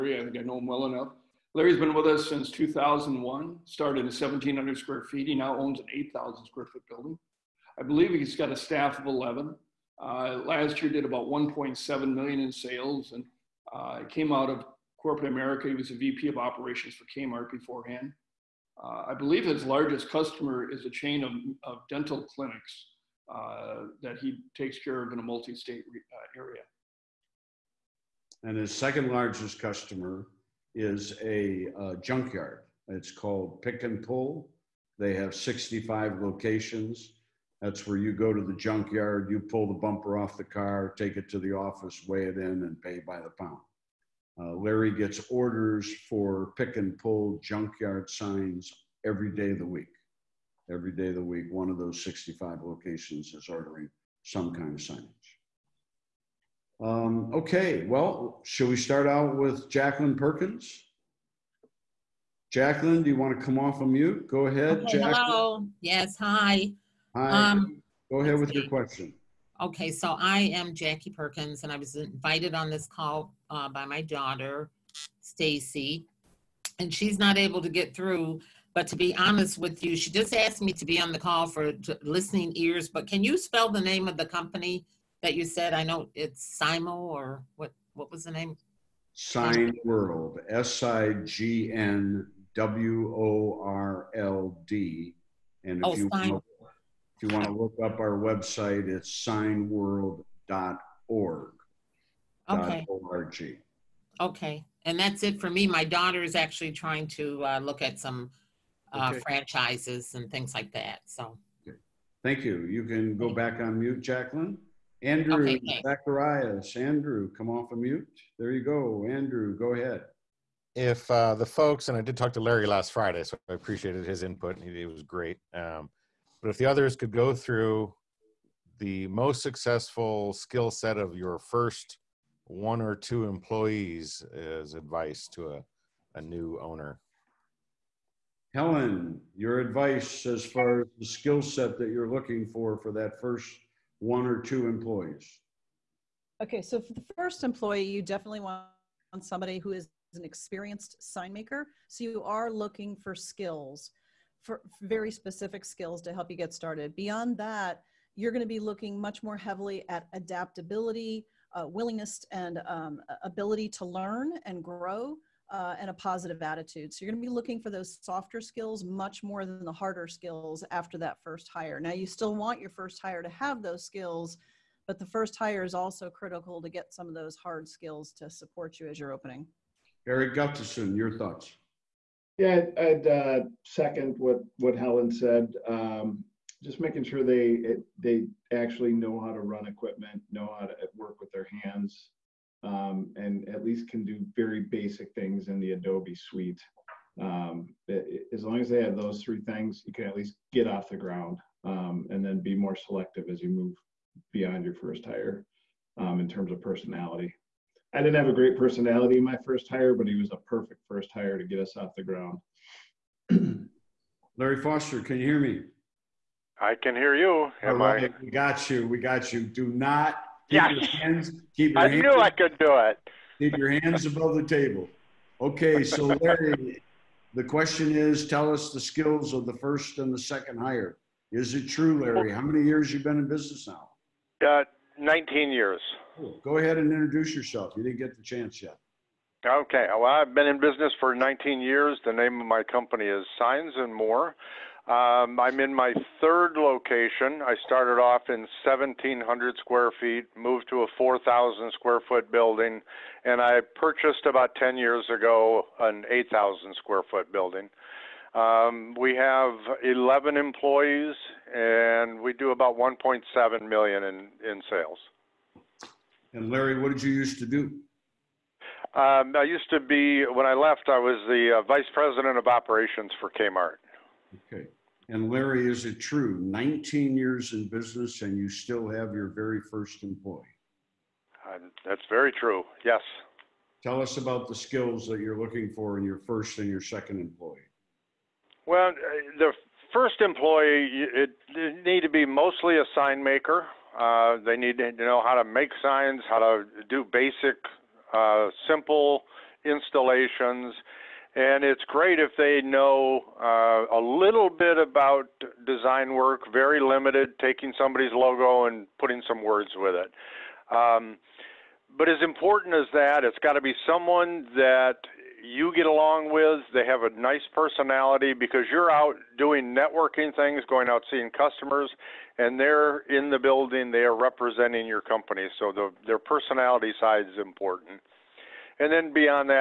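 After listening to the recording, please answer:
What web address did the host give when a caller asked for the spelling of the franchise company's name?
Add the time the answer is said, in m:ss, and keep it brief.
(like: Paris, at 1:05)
signworld.org, at 1:39.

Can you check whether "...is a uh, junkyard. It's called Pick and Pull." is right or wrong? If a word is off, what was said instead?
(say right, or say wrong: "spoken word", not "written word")
right.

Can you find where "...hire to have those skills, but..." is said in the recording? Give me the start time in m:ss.
2:53.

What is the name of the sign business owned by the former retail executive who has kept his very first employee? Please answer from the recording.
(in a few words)
Signs and More.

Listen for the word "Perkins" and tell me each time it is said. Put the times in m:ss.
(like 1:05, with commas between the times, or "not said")
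1:00, 1:11.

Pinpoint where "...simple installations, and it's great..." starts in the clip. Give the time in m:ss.
4:58.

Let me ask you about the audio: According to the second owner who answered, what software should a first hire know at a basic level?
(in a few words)
Adobe suite.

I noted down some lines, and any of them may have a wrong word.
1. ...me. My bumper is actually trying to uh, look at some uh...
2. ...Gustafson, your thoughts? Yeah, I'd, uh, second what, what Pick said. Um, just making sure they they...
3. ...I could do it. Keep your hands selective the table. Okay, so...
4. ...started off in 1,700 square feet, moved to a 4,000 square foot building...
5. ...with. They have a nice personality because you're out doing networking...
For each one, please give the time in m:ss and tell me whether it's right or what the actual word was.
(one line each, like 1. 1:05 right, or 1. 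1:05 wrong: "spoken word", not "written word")
1. 1:45 wrong: "daughter", not "bumper"
2. 3:00 wrong: "Helen", not "Pick"
3. 3:42 wrong: "above", not "selective"
4. 4:07 right
5. 5:16 right.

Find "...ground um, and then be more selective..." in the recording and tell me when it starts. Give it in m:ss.
3:20.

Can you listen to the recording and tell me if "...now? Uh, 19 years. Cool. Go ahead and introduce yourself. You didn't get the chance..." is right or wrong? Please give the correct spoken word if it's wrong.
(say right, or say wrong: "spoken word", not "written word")
right.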